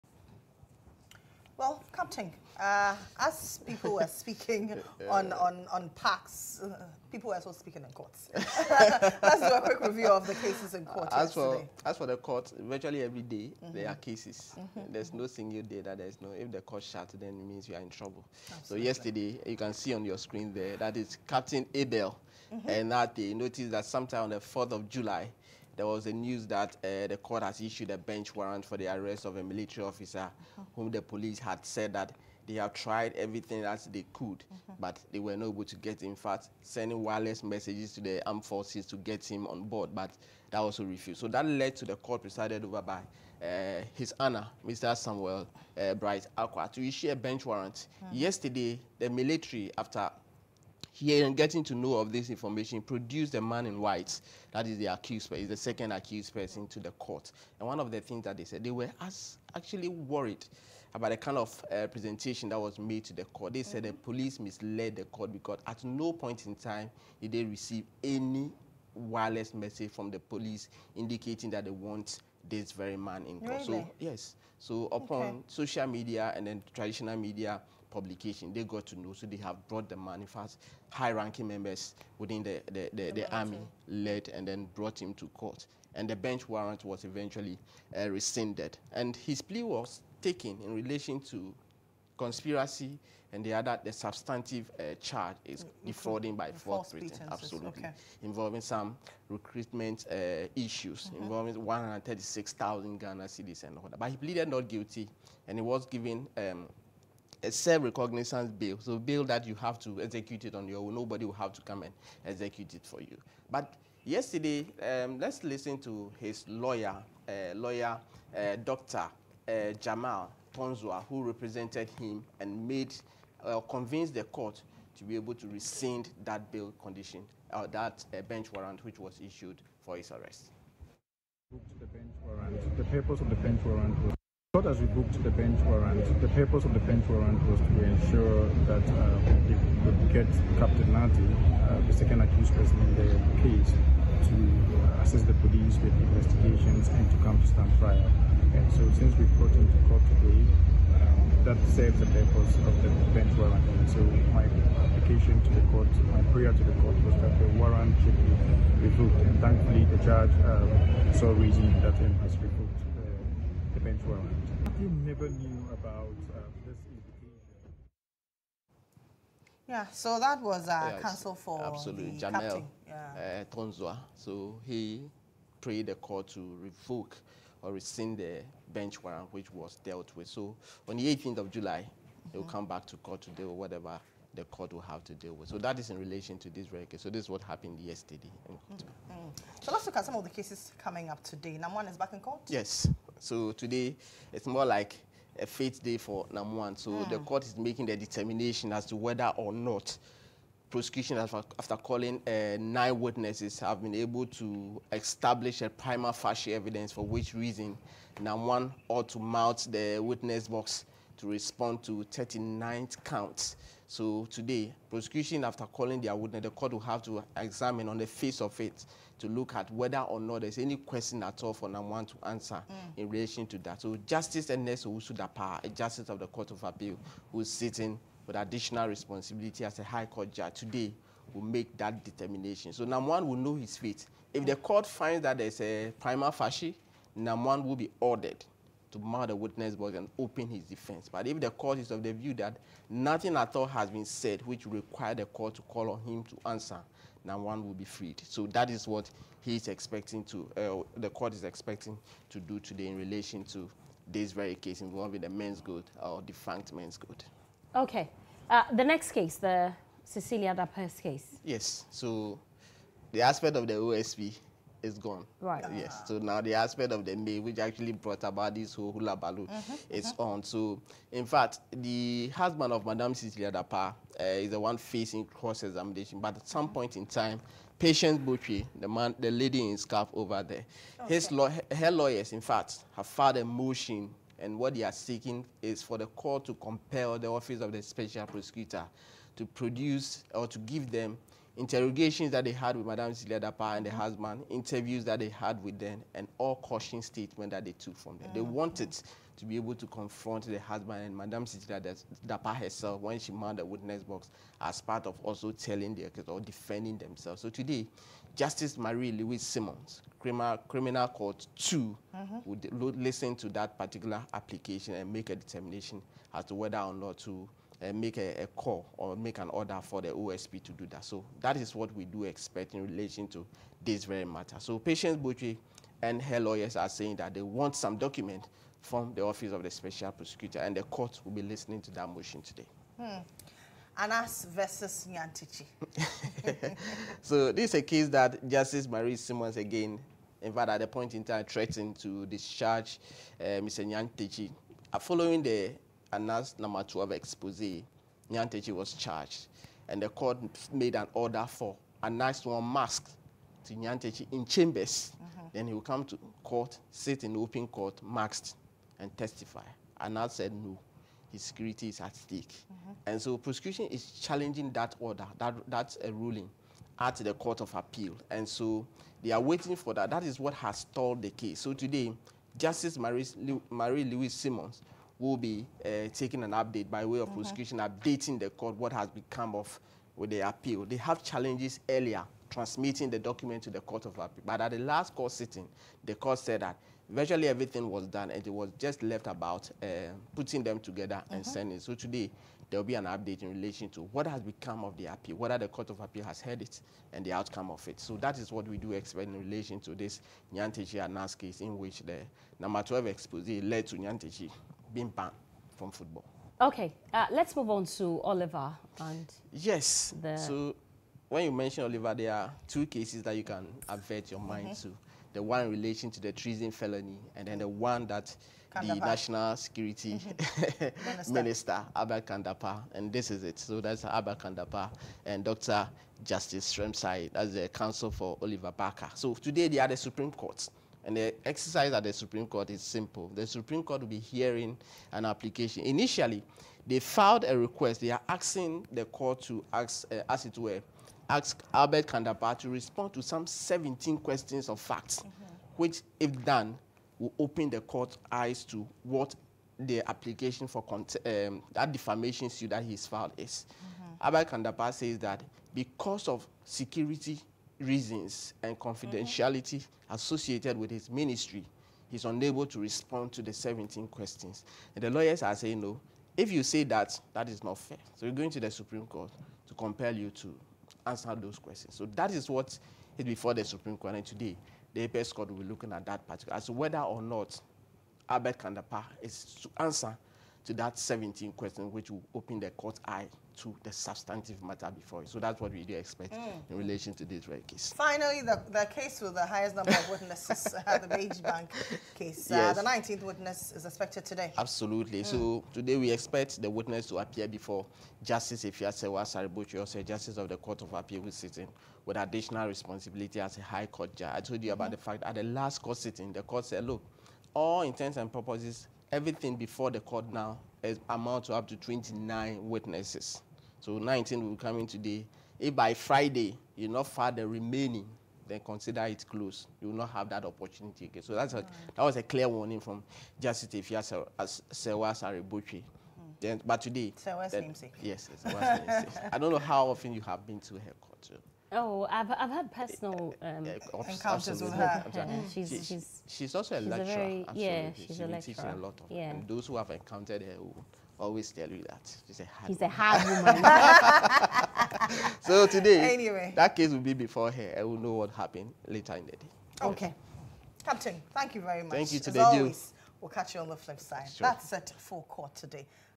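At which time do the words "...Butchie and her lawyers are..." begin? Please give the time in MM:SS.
05:25.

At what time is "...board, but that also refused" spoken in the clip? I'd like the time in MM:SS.
00:39.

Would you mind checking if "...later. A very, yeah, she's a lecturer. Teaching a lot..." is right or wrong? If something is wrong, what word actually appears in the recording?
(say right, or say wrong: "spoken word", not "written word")
wrong: "lecturer", not "later".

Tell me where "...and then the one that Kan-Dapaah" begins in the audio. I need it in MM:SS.
06:57.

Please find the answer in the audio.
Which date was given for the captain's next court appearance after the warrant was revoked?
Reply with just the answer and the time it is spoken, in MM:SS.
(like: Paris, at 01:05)
18th of July, at 03:01.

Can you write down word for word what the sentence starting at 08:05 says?
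So that's what we do expect mm.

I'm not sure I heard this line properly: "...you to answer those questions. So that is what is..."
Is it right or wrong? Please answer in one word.
right.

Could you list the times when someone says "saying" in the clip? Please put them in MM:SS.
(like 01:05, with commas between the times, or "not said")
05:26, 07:45.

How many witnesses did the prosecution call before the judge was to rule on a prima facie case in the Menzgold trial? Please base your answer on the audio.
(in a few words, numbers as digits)
9.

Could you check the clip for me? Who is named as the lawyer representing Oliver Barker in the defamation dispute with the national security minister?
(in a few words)
Justice Srem-Sai.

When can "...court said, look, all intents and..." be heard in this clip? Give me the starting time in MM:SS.
08:26.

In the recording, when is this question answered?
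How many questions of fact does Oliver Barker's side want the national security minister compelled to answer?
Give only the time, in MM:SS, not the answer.
07:23.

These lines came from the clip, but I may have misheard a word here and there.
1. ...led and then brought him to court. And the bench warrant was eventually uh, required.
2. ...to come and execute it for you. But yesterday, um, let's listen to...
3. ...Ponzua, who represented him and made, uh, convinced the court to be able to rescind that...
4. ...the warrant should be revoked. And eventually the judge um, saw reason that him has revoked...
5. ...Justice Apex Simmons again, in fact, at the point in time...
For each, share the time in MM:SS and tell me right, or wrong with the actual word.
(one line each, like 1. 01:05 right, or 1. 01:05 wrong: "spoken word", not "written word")
1. 01:23 wrong: "rescinded", not "required"
2. 01:51 right
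3. 02:00 right
4. 02:37 wrong: "thankfully", not "eventually"
5. 05:38 wrong: "Marie", not "Apex".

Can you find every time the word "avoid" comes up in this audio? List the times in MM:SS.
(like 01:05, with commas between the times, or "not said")
not said.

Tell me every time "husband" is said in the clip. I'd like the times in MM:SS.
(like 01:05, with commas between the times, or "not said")
04:32, 04:53, 05:00.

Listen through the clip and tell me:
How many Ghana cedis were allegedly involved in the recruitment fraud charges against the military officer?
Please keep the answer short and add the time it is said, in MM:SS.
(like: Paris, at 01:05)
136,000, at 01:41.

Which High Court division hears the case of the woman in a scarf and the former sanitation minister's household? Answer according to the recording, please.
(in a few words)
Criminal Court 2.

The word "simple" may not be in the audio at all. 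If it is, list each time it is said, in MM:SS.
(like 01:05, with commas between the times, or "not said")
07:12.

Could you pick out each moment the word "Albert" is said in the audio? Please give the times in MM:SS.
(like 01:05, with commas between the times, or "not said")
07:21, 07:34, 07:58.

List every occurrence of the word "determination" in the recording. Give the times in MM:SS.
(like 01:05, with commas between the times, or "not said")
03:17, 03:52, 05:15.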